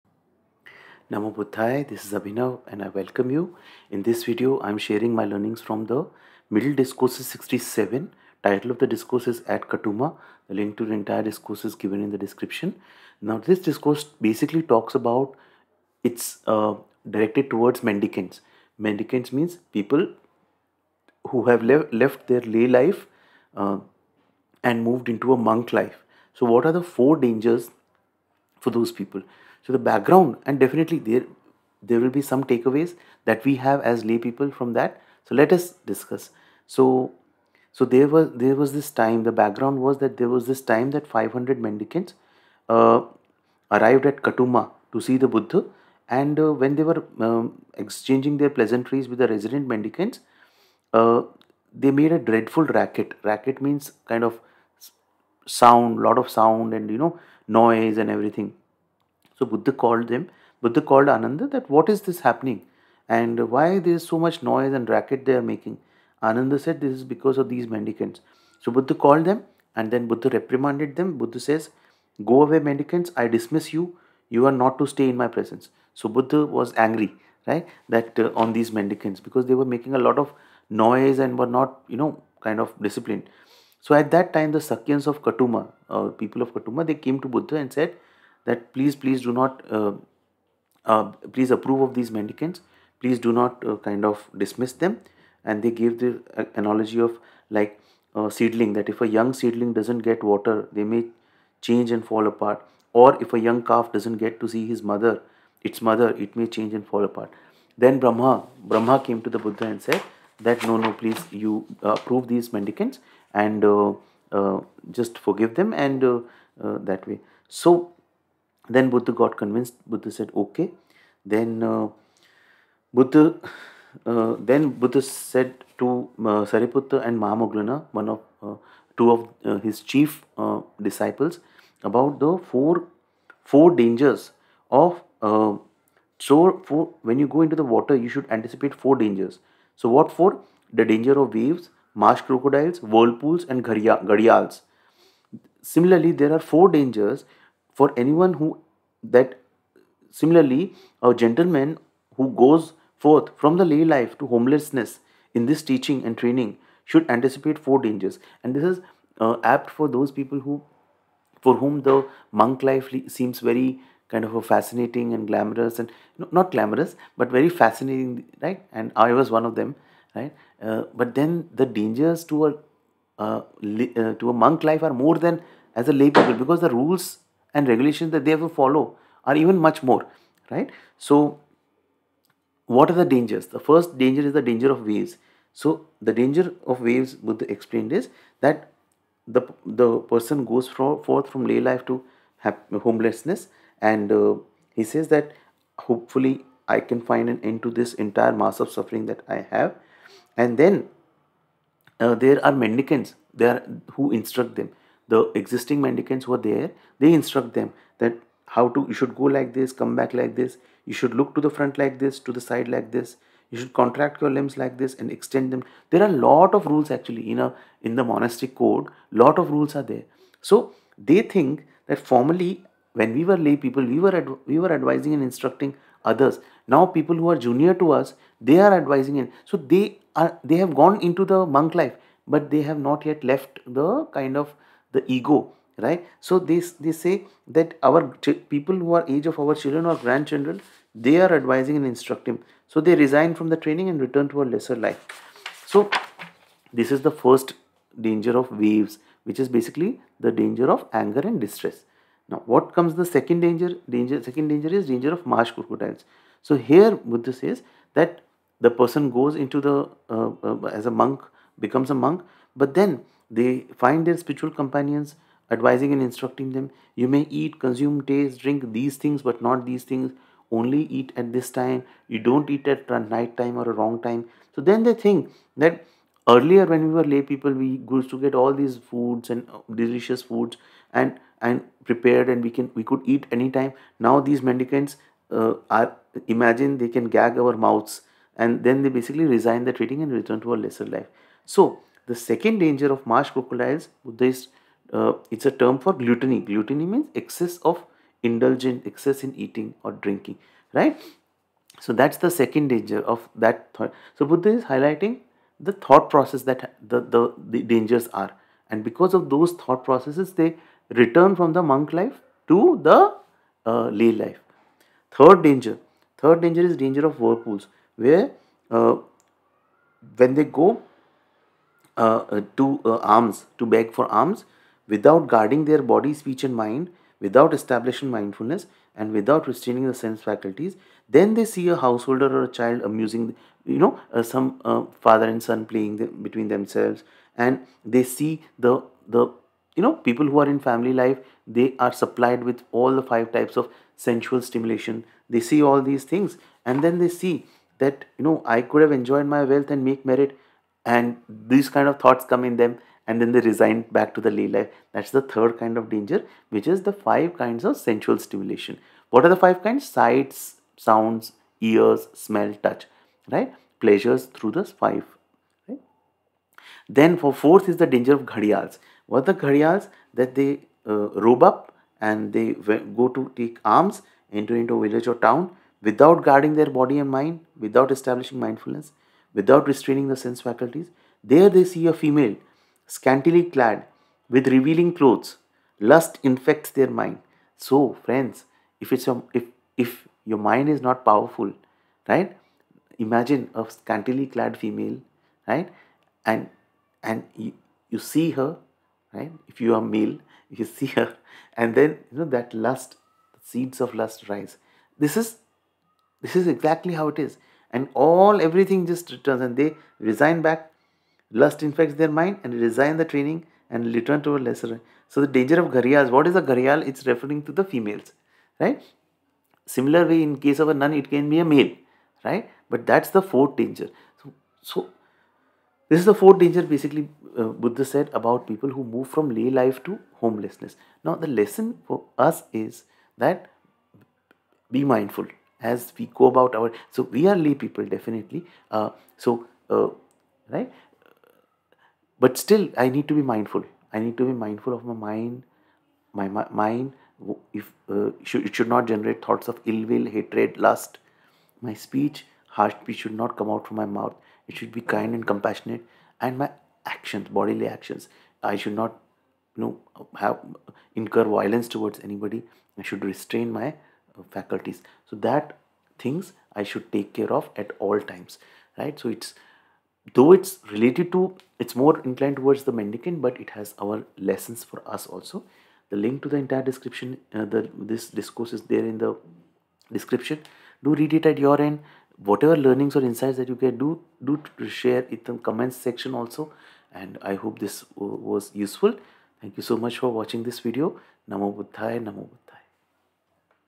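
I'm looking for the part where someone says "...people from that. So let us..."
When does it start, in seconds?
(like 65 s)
34 s.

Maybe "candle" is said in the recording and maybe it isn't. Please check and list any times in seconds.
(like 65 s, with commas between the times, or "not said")
not said.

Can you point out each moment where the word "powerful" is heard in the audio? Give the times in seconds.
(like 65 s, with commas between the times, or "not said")
391 s.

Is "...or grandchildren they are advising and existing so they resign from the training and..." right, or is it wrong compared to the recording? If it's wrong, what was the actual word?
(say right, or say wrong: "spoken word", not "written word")
wrong: "instructing", not "existing".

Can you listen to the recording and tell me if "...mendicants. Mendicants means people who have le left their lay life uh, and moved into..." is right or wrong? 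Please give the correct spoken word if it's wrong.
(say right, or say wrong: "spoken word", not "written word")
right.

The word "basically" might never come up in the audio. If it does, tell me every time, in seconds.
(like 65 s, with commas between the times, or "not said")
14 s, 249 s, 288 s, 426 s.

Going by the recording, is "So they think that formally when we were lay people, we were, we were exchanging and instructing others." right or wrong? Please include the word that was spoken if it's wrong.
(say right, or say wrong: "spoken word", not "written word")
wrong: "advising", not "exchanging".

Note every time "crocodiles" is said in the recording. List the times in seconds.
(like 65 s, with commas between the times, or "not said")
142 s, 255 s, 293 s.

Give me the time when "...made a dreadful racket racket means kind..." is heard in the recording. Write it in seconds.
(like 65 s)
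51 s.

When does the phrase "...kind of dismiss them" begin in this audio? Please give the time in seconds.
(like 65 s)
93 s.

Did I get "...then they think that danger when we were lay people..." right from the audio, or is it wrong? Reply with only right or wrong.
wrong.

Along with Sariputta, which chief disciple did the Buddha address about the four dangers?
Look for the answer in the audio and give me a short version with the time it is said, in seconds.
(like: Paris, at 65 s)
Mahamoggallana, at 127 s.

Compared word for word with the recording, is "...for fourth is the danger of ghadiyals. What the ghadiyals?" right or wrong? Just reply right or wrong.
right.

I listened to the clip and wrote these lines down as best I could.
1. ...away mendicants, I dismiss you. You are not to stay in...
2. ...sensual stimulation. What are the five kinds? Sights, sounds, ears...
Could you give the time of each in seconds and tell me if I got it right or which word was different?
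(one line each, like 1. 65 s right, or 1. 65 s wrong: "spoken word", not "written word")
1. 72 s right
2. 357 s right.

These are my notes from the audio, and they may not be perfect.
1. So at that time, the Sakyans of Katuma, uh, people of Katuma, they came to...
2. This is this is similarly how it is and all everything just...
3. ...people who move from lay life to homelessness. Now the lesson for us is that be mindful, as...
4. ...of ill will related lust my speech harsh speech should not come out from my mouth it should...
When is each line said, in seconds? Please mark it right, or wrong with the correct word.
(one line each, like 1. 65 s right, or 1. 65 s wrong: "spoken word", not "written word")
1. 83 s right
2. 404 s wrong: "exactly", not "similarly"
3. 428 s right
4. 449 s wrong: "hatred", not "related".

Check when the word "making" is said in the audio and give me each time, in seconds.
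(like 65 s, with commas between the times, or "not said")
65 s, 79 s.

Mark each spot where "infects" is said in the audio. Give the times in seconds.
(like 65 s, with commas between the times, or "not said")
386 s, 411 s.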